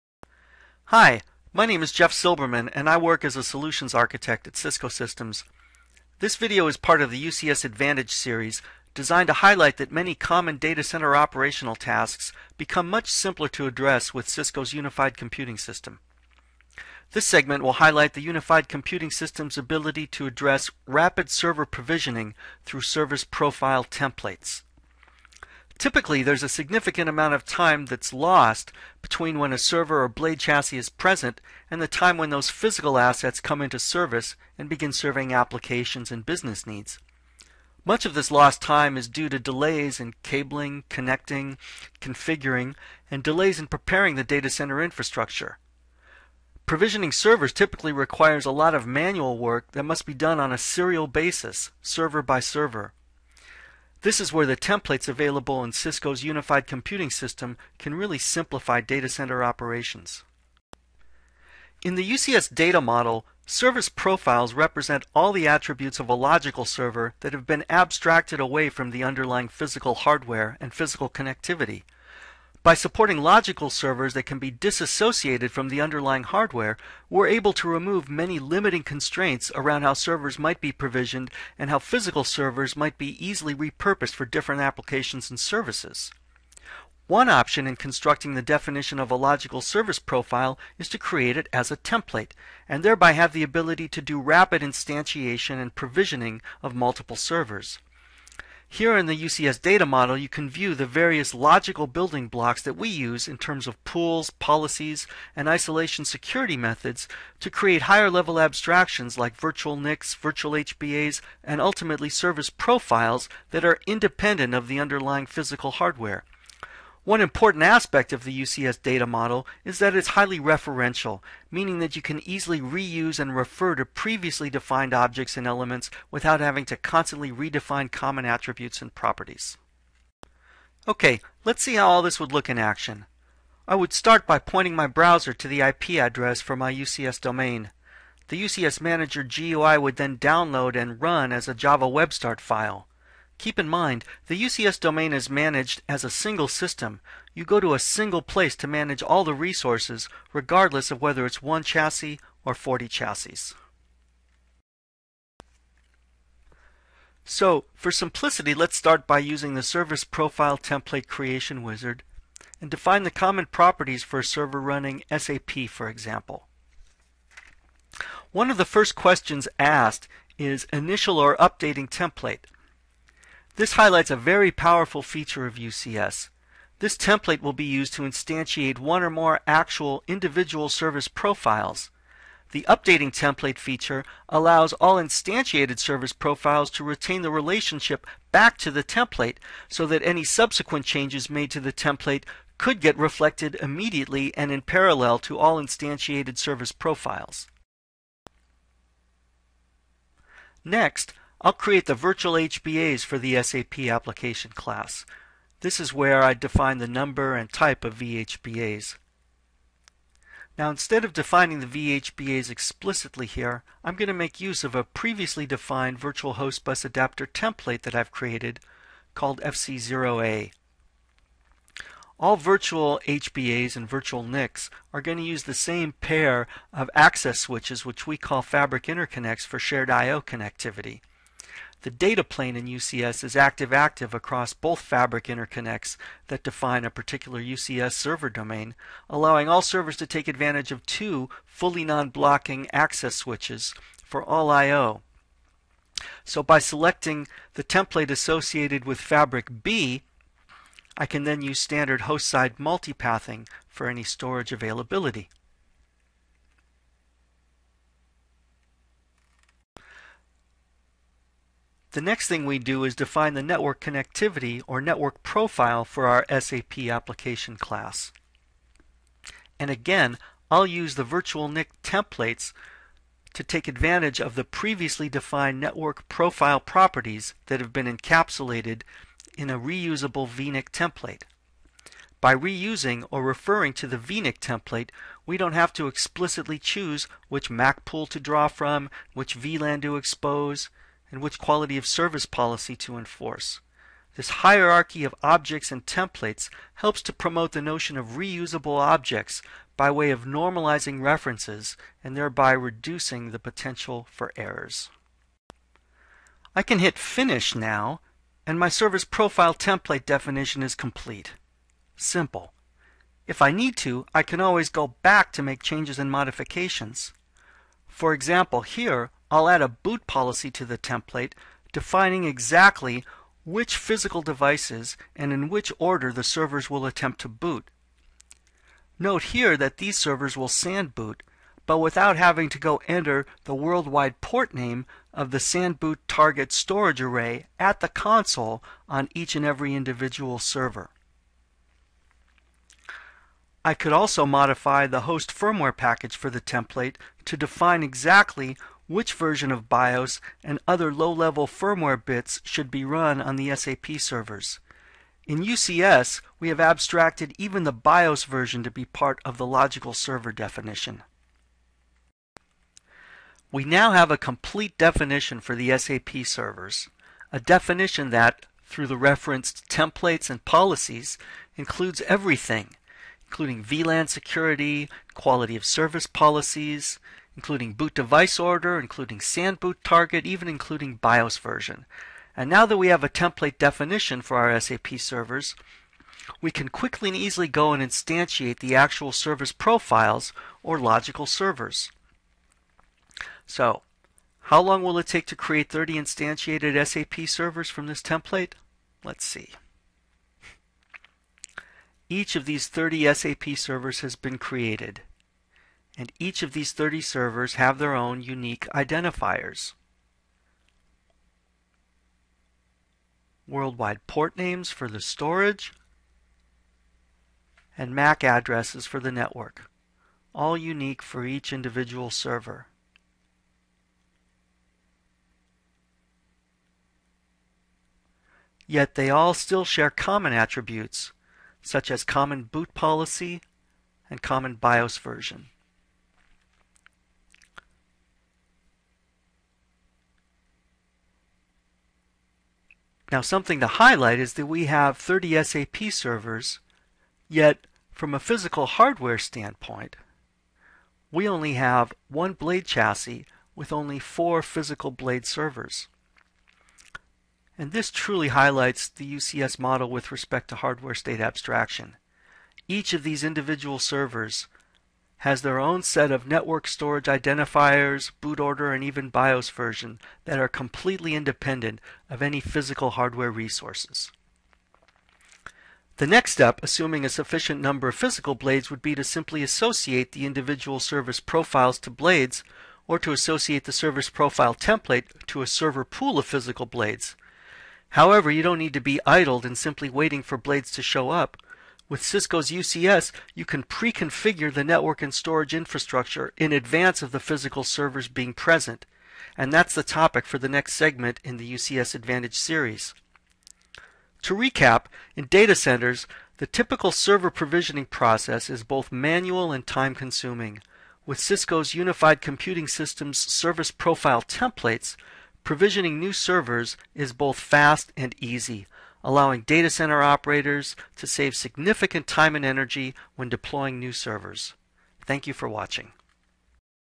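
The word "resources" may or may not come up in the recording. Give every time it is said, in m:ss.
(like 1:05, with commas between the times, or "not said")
2:29, 7:53.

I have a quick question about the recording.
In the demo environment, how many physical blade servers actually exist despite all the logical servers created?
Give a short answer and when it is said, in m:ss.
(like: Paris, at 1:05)
4, at 7:33.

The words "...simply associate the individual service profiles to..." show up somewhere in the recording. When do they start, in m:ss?
7:59.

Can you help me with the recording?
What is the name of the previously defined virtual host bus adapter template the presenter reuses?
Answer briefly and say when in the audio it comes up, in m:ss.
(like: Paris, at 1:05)
FC0A, at 3:39.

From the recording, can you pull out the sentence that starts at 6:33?
So, how long will it take to create 30 instantiated SAP servers from this template?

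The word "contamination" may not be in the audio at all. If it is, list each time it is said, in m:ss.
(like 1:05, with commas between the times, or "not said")
not said.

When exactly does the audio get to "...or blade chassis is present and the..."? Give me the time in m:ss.
0:30.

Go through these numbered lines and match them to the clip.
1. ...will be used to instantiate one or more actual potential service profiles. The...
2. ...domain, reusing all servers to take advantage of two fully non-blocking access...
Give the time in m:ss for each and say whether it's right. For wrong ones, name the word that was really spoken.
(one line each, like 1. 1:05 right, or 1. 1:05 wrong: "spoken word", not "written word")
1. 2:57 wrong: "individual", not "potential"
2. 3:58 wrong: "allowing", not "reusing".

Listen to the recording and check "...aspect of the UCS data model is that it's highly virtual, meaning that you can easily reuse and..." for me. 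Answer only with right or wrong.
wrong.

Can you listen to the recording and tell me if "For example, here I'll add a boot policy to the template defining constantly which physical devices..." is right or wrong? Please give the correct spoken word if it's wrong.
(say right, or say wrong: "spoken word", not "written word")
wrong: "exactly", not "constantly".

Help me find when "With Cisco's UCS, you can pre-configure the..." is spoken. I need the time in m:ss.
8:11.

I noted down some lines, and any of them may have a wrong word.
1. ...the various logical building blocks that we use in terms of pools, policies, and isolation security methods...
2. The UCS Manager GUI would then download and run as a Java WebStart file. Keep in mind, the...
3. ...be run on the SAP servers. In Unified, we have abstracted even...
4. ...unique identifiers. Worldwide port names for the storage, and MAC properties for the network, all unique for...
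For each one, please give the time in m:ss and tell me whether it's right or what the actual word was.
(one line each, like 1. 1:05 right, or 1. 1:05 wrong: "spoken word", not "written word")
1. 1:40 right
2. 2:18 right
3. 5:52 wrong: "UCS", not "Unified"
4. 6:48 wrong: "addresses", not "properties".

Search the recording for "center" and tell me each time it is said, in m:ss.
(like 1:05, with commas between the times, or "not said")
0:10, 0:44, 0:59, 8:25, 8:39.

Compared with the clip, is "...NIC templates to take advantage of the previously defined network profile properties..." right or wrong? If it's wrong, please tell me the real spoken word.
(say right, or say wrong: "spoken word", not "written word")
right.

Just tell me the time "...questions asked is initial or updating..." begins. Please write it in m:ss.
2:48.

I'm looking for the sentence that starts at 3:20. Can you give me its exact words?
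Next, I'll create the virtual HBAs for the SAP application class.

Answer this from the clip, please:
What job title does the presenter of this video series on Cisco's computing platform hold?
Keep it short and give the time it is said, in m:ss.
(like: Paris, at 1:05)
Solutions architect, at 0:03.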